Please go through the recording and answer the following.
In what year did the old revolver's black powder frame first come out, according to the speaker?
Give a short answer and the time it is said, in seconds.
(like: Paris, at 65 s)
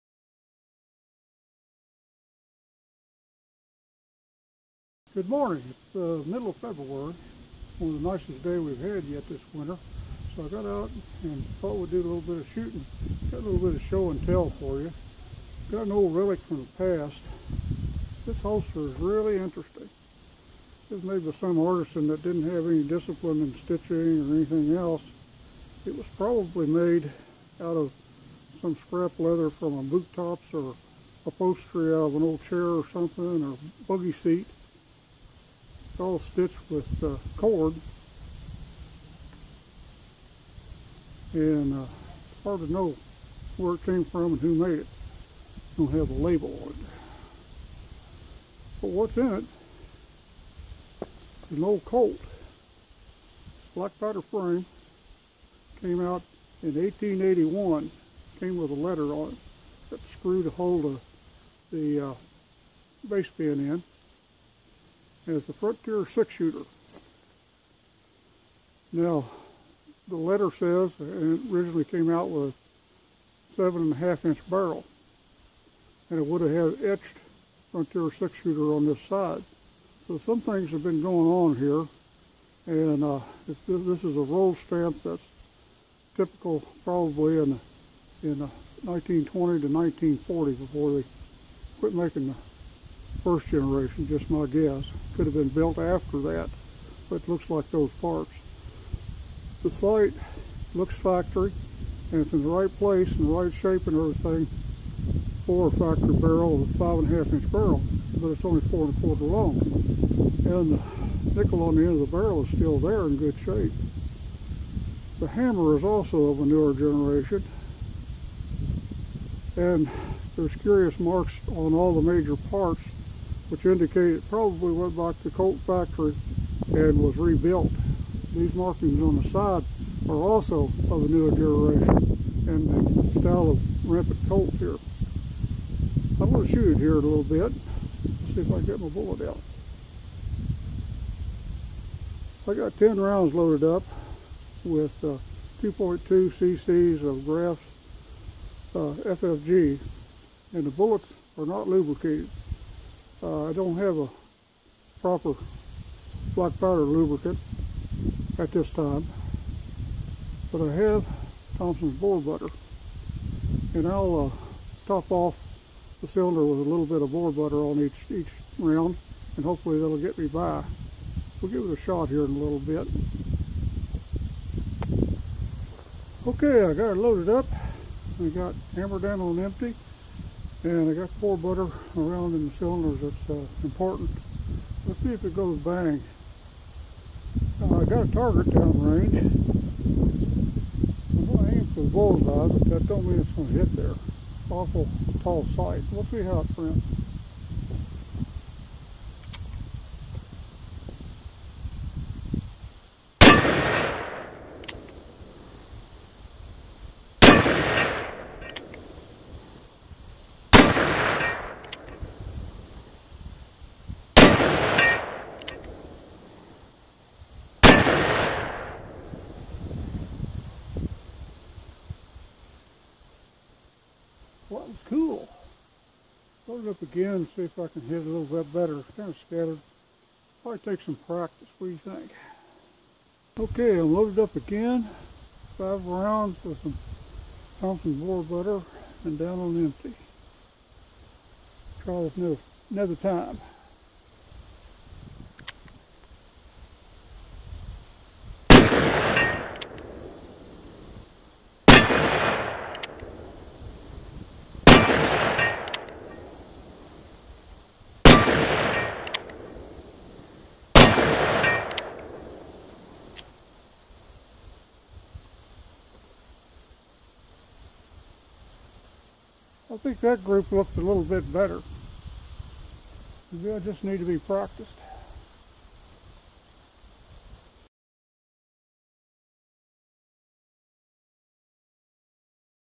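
1881, at 56 s.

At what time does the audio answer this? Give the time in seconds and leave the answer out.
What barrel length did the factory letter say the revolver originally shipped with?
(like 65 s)
73 s.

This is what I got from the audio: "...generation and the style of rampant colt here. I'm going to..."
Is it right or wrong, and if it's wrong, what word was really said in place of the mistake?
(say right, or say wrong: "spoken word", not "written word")
right.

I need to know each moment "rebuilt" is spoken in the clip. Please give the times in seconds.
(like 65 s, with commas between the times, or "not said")
127 s.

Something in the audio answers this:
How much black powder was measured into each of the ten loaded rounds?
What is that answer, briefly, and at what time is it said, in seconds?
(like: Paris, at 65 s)
2.2 cc, at 145 s.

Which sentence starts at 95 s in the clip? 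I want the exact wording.
Could have been built after that, but it looks like those parts.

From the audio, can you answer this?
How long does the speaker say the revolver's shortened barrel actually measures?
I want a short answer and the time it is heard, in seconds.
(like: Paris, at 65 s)
4.25 inches, at 108 s.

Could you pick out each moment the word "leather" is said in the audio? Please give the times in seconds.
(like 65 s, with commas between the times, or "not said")
29 s.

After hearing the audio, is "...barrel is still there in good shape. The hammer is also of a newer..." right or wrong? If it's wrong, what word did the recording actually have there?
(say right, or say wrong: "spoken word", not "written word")
right.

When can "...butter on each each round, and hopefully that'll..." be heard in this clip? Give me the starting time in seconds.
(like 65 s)
167 s.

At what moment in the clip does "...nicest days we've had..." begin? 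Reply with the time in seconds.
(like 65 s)
8 s.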